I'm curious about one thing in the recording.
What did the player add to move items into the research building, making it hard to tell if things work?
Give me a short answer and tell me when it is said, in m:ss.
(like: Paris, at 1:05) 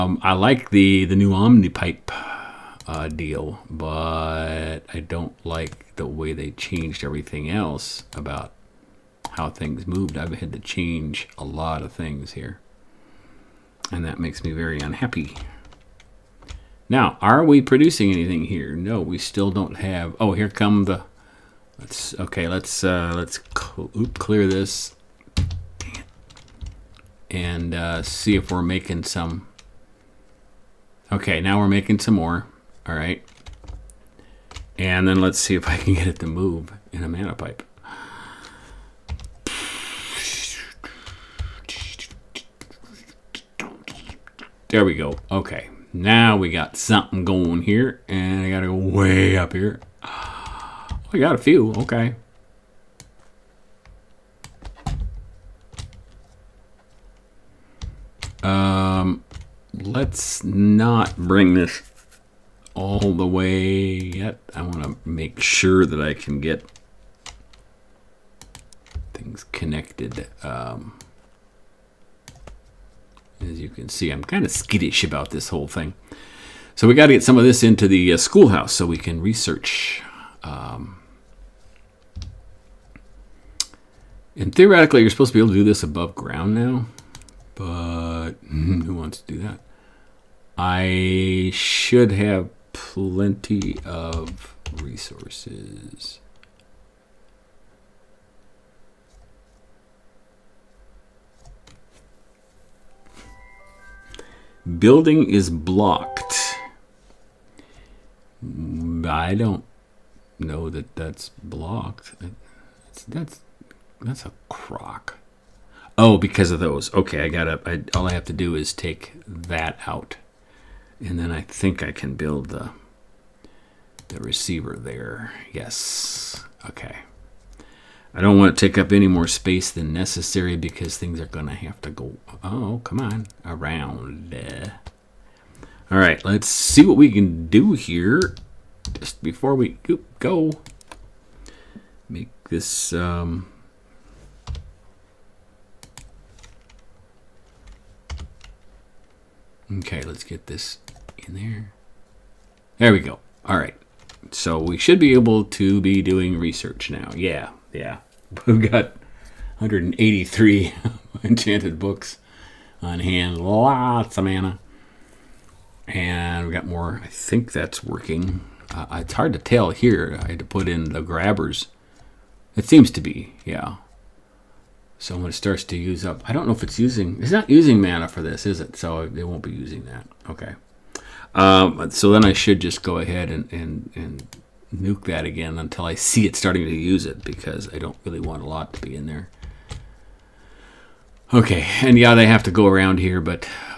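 grabbers, at 2:51.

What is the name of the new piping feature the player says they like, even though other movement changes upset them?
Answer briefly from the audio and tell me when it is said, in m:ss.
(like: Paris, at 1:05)
Omnipipe, at 0:01.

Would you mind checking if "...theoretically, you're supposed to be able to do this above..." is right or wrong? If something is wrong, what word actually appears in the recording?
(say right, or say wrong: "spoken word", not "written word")
right.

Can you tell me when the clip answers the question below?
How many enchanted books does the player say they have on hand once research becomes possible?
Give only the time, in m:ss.
2:39.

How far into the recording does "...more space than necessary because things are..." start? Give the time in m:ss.
2:09.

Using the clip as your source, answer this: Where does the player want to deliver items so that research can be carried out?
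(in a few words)
schoolhouse.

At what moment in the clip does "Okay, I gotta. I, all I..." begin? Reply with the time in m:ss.
1:56.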